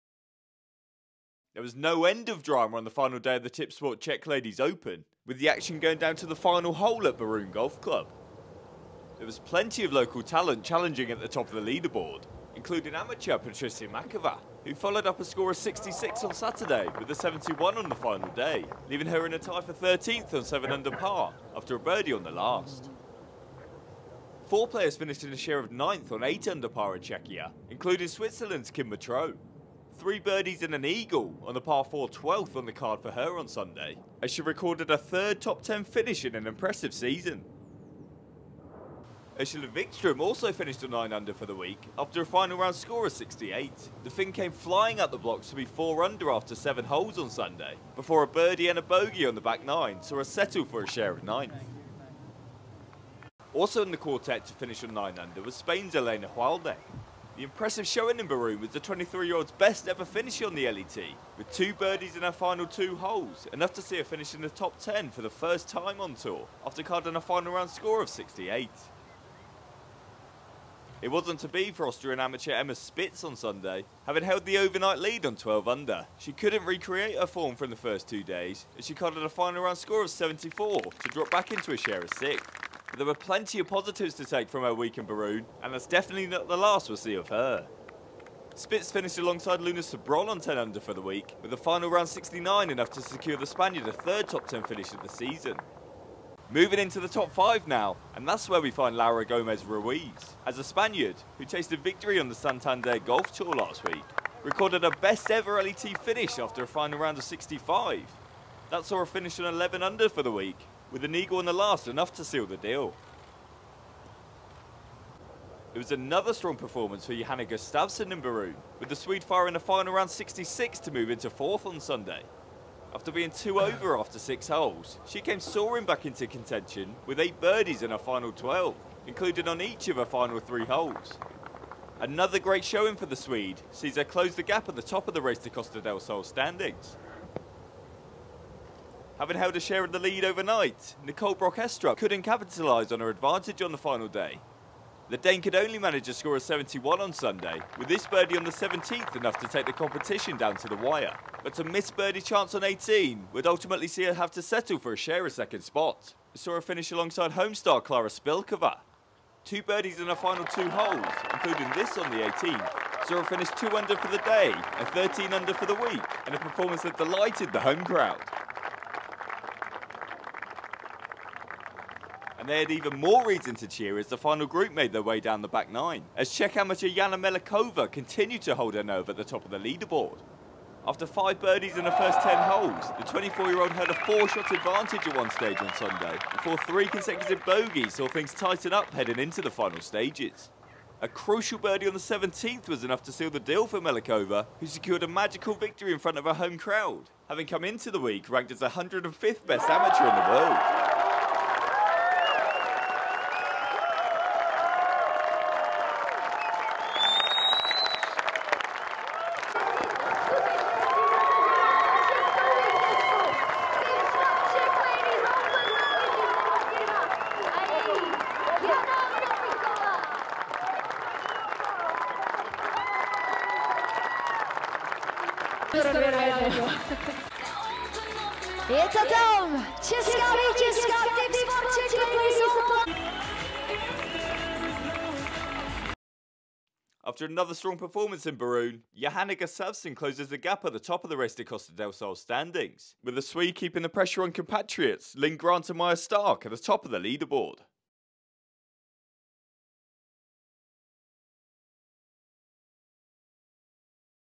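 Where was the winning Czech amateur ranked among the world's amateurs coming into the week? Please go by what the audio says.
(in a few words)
105th.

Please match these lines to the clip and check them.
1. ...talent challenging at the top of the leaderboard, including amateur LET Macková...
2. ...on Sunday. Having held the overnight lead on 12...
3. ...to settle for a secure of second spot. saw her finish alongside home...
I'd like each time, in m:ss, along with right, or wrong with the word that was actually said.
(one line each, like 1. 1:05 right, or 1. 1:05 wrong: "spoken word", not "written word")
1. 0:10 wrong: "Patricia", not "LET"
2. 1:13 right
3. 2:34 wrong: "share", not "secure".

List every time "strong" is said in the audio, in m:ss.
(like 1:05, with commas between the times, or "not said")
1:56, 3:57.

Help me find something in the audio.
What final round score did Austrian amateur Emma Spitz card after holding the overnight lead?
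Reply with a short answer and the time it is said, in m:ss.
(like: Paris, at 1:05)
74, at 1:20.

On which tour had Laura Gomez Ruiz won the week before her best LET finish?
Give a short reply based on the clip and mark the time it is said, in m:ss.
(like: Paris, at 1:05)
Santander Golf Tour, at 1:42.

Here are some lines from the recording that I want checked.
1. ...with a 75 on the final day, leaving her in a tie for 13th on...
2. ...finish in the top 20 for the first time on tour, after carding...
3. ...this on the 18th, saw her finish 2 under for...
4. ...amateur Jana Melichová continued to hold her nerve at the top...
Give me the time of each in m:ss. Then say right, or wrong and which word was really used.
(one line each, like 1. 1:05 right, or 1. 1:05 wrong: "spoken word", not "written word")
1. 0:16 wrong: "71", not "75"
2. 1:04 wrong: "10", not "20"
3. 2:41 right
4. 2:56 right.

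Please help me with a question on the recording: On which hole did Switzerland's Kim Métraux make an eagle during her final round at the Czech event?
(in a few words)
par 4 12th.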